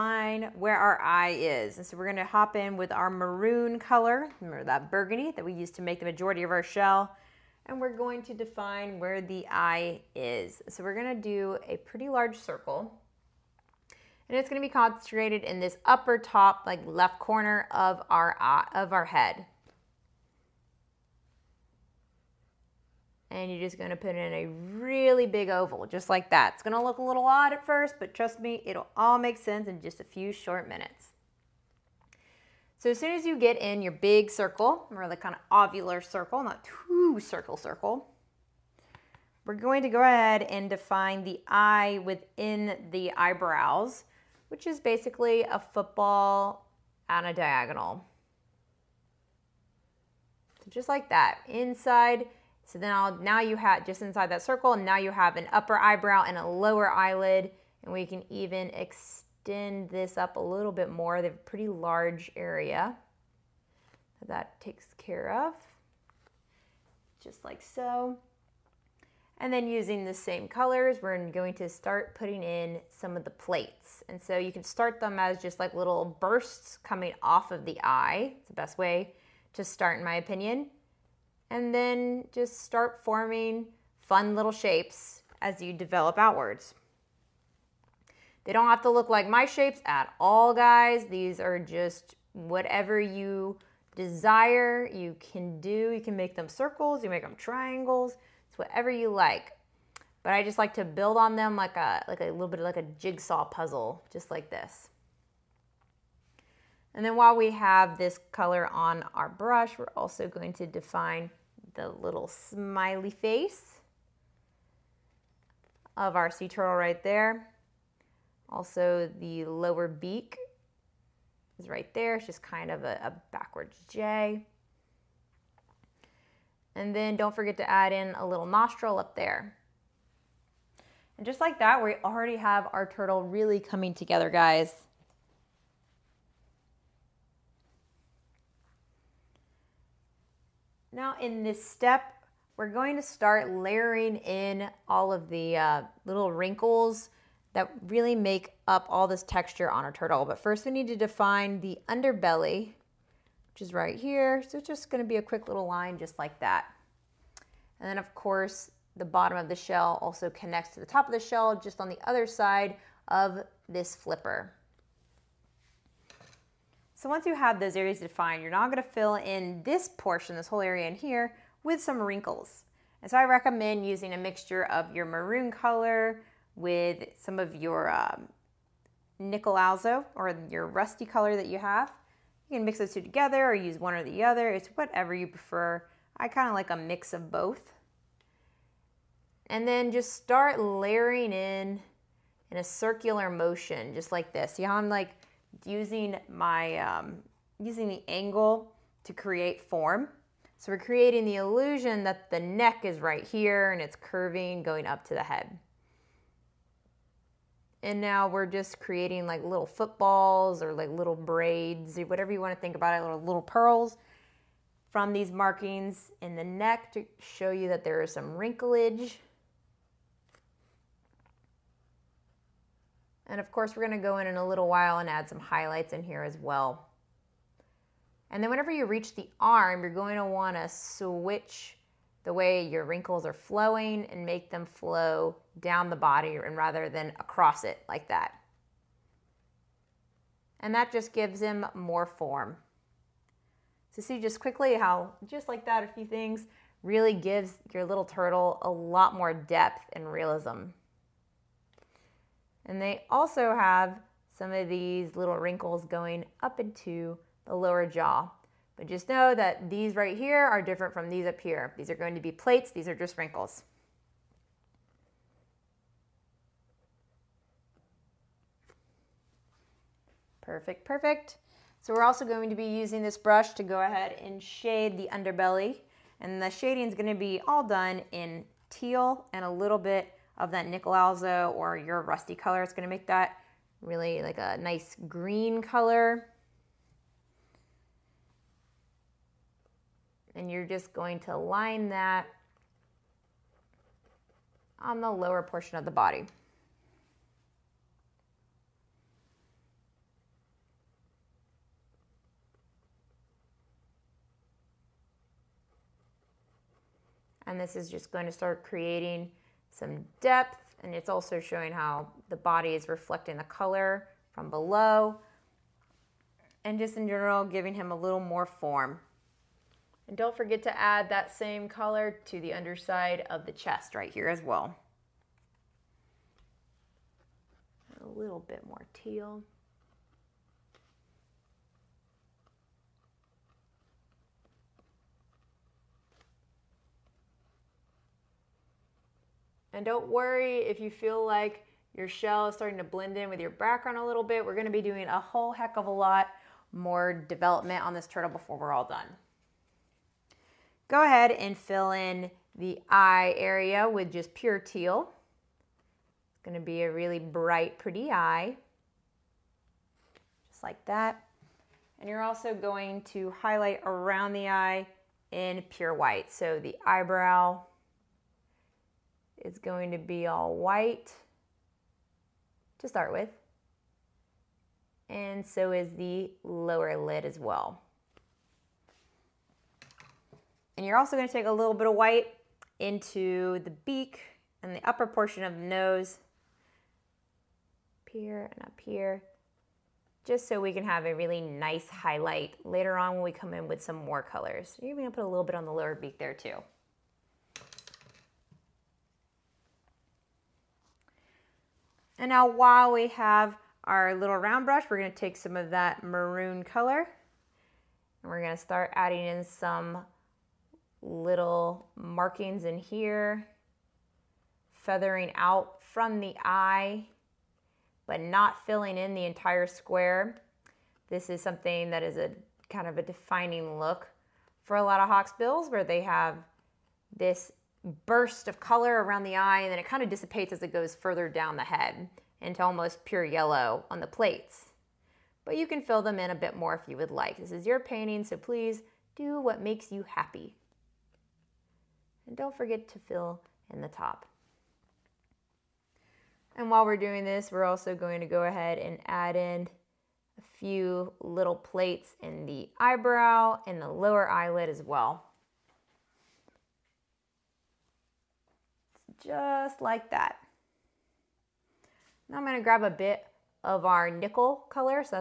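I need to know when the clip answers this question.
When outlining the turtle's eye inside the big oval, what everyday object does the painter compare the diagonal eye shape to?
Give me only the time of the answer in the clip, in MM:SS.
00:45.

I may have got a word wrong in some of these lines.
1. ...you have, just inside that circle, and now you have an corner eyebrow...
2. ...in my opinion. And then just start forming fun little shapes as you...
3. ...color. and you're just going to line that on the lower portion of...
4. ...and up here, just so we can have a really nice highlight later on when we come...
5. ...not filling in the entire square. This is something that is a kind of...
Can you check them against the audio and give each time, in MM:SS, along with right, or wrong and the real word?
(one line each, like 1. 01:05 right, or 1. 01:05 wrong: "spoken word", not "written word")
1. 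00:53 wrong: "upper", not "corner"
2. 01:19 right
3. 04:45 right
4. 06:28 right
5. 06:58 right.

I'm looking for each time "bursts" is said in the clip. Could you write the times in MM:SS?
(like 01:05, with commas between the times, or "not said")
01:16, 07:08.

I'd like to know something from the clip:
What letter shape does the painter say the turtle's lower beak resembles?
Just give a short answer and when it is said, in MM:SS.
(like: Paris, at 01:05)
a backwards J, at 02:03.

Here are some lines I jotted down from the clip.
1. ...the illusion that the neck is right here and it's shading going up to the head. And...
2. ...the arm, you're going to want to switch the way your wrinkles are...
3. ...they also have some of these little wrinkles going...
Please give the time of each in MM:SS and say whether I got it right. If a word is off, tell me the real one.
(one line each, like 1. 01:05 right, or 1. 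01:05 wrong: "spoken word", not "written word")
1. 03:21 wrong: "curving", not "shading"
2. 03:49 right
3. 04:12 right.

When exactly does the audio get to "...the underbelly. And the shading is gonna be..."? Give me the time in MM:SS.
04:34.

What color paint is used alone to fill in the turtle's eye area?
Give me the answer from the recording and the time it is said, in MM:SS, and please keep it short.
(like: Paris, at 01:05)
pure teal, at 05:54.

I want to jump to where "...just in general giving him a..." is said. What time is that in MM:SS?
05:16.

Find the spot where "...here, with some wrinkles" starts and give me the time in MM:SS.
02:50.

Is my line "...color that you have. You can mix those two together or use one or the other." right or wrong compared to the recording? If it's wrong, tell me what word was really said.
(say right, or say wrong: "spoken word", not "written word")
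right.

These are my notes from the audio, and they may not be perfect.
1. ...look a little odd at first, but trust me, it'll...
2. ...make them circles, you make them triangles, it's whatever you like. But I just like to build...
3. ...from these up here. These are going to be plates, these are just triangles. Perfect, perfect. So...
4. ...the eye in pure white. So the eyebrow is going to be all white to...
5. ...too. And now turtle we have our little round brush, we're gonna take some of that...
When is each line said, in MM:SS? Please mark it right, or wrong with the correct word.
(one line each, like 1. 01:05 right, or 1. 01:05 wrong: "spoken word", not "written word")
1. 00:26 right
2. 01:36 right
3. 04:20 wrong: "wrinkles", not "triangles"
4. 06:04 right
5. 06:36 wrong: "while", not "turtle".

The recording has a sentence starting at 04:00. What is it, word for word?
And that just gives him more form.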